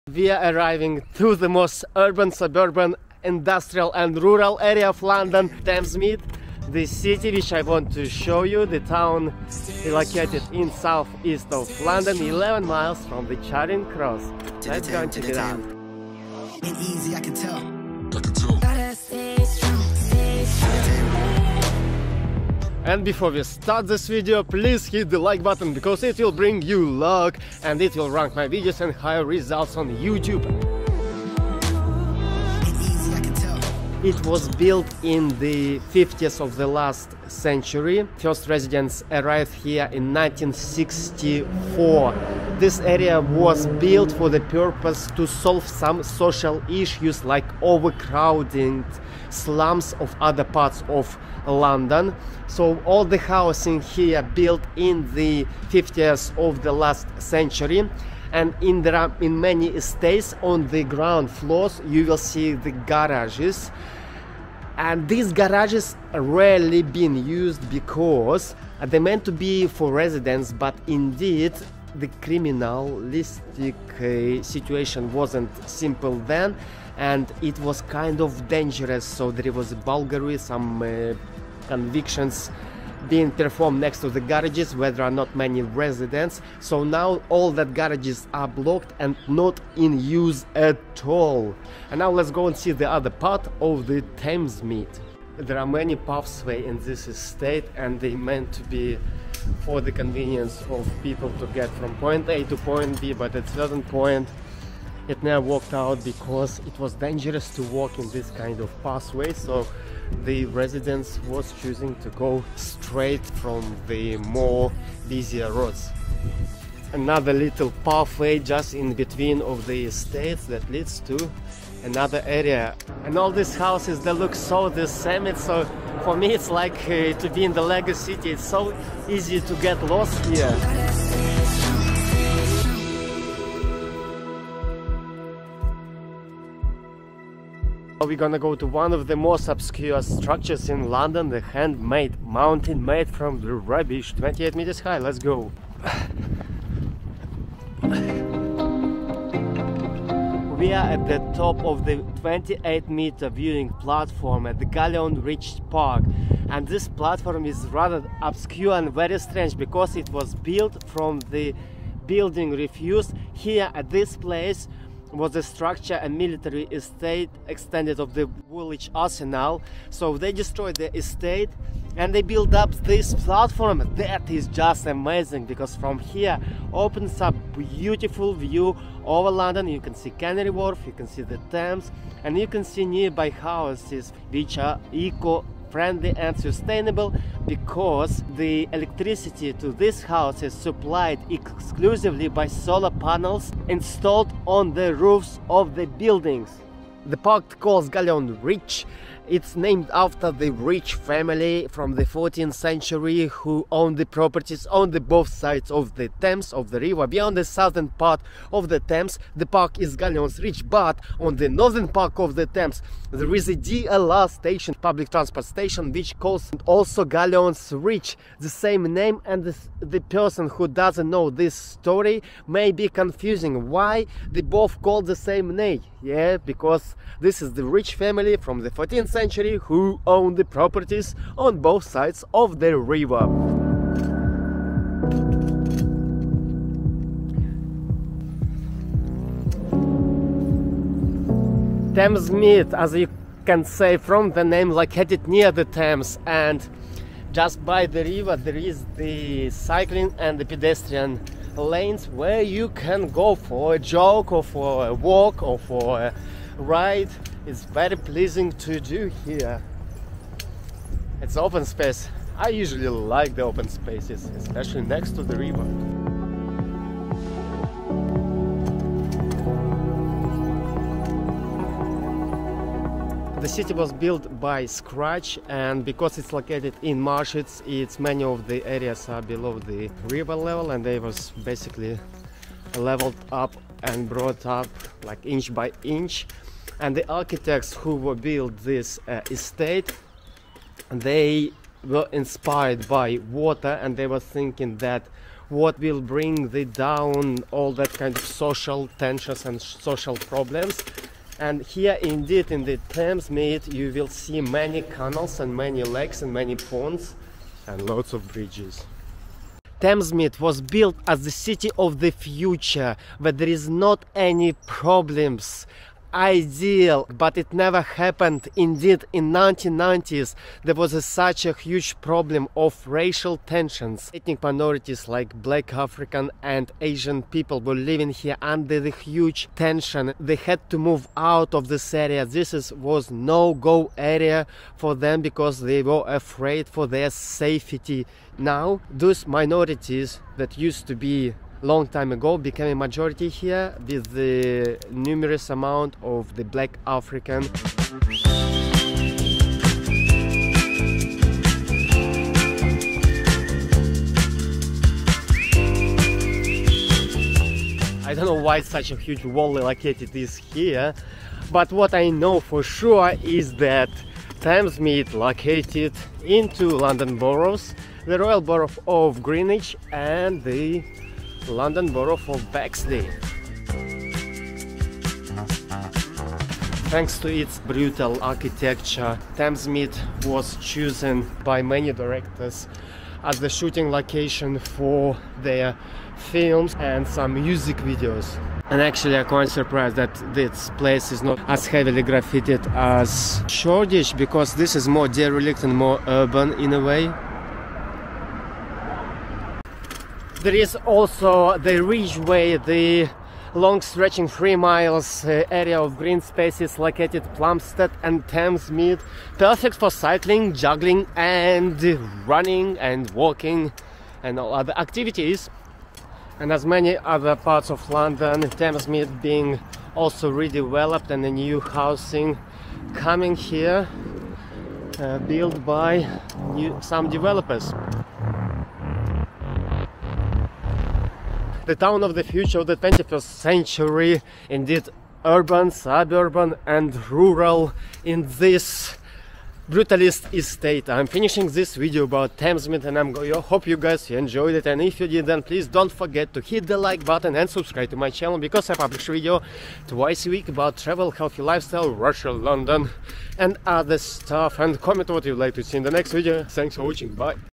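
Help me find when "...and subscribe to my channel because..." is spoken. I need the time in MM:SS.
07:27.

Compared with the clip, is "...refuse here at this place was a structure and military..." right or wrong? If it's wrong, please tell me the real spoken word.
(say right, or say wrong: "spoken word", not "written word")
right.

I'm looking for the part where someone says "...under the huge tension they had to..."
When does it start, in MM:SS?
05:28.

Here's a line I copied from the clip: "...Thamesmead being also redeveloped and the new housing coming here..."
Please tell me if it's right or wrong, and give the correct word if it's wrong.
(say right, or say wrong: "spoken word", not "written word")
right.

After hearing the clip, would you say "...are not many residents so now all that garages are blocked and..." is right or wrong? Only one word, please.
right.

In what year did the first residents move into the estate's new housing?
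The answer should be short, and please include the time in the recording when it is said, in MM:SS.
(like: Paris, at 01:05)
1964, at 00:40.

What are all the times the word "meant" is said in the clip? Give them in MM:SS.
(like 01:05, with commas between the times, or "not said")
01:08, 01:38.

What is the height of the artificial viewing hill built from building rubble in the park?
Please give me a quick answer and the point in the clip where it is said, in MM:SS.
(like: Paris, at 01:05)
28 meters, at 02:24.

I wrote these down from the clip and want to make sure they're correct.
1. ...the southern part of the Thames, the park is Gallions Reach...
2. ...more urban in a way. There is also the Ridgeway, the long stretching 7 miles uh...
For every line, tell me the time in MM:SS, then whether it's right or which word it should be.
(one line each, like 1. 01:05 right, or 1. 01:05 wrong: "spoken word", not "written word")
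1. 03:27 right
2. 06:35 wrong: "3", not "7".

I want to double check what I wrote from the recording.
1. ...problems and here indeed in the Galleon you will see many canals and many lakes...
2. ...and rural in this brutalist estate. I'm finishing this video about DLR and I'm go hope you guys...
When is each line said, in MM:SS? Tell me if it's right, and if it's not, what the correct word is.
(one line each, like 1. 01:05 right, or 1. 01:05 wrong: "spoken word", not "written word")
1. 05:00 wrong: "Thamesmead", not "Galleon"
2. 07:16 wrong: "Thamesmead", not "DLR".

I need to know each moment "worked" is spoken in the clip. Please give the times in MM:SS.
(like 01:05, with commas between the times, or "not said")
01:45.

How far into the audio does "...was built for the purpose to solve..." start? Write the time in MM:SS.
00:43.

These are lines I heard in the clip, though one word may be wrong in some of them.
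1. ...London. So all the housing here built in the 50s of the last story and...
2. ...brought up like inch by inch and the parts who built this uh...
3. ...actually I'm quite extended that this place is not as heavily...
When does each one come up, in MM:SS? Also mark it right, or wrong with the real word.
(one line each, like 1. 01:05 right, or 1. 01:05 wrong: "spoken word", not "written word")
1. 00:51 wrong: "century", not "story"
2. 04:44 wrong: "architects", not "parts"
3. 06:28 wrong: "surprised", not "extended".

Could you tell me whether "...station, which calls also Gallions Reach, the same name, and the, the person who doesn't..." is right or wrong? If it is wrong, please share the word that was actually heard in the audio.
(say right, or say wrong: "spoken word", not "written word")
right.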